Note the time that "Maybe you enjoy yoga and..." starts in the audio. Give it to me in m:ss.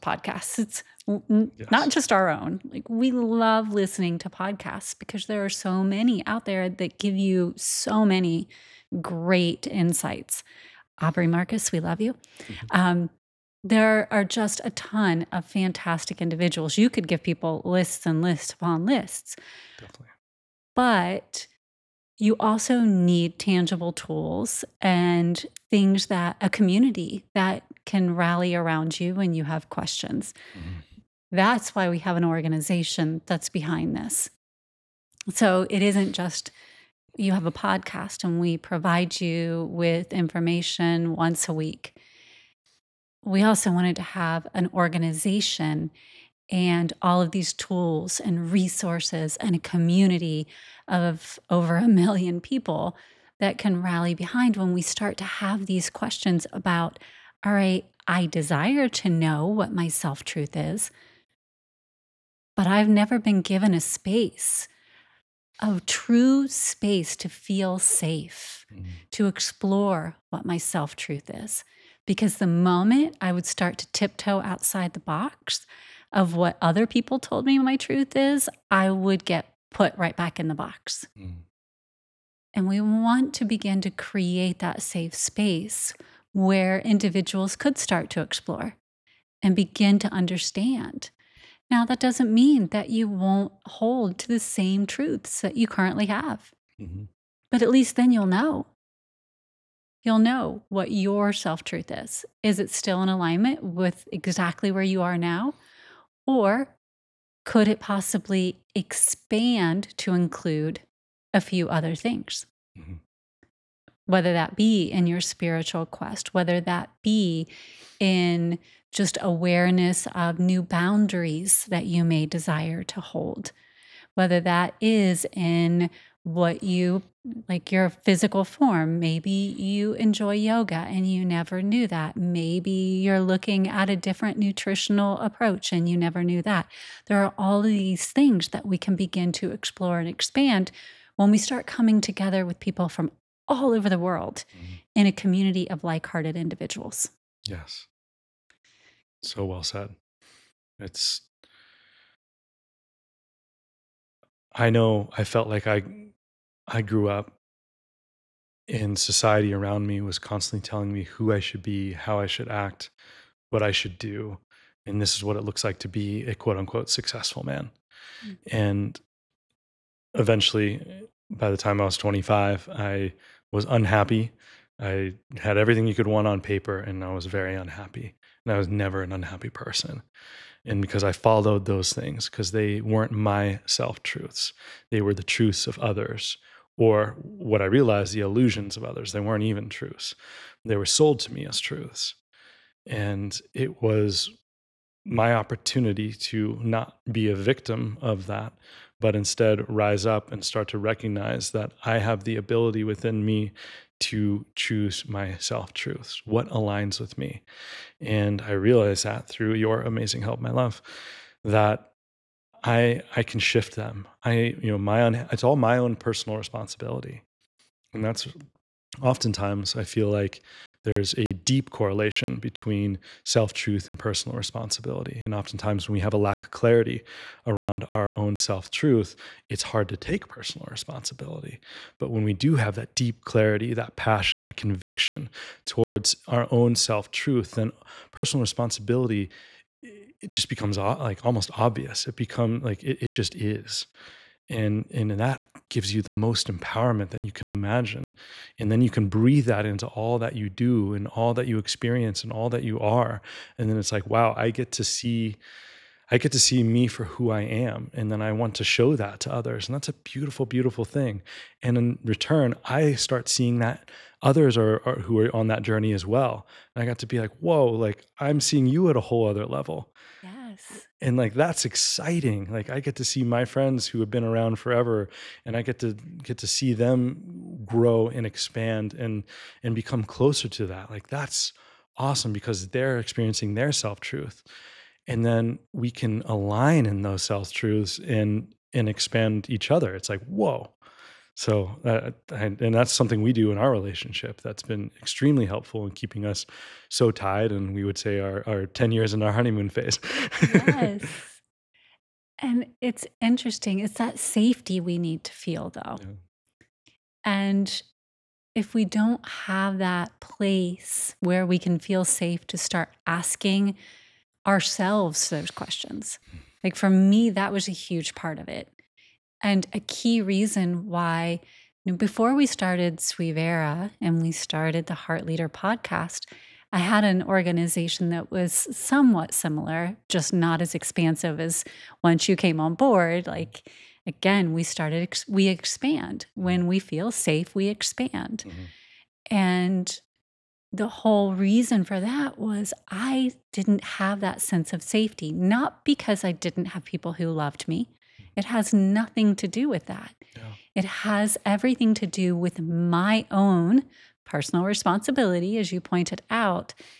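2:08.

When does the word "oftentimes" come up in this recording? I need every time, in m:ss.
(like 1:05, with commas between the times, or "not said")
3:39, 3:45.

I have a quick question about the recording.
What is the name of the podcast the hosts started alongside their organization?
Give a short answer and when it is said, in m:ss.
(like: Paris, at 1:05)
Heart Leader podcast, at 5:24.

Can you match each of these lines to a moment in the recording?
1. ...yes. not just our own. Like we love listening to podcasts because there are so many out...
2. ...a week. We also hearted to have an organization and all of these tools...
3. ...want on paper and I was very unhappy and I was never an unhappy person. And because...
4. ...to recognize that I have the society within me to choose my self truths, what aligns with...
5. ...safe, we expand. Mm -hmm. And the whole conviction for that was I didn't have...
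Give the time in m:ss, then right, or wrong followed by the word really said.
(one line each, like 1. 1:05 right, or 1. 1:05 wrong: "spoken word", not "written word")
1. 0:01 right
2. 0:41 wrong: "wanted", not "hearted"
3. 2:56 right
4. 3:20 wrong: "ability", not "society"
5. 5:37 wrong: "reason", not "conviction".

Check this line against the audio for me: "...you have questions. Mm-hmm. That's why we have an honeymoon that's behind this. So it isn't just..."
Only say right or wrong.
wrong.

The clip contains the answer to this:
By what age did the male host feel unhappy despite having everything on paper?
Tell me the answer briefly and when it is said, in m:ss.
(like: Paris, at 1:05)
25, at 2:51.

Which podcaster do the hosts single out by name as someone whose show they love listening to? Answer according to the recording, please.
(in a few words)
Aubrey Marcus.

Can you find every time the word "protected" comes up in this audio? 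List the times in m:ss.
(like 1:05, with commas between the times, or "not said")
not said.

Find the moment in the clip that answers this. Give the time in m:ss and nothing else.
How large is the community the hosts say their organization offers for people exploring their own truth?
0:51.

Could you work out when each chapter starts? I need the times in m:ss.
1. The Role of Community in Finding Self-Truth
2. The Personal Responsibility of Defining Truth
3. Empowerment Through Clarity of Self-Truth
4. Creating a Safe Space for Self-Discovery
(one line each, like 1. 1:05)
1. 0:19
2. 2:23
3. 3:52
4. 5:29.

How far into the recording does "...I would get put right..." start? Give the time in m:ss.
1:18.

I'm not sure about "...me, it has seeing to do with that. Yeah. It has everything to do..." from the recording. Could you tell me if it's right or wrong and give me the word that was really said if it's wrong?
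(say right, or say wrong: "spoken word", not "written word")
wrong: "nothing", not "seeing".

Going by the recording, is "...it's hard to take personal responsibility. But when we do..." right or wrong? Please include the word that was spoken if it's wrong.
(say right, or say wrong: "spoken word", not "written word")
right.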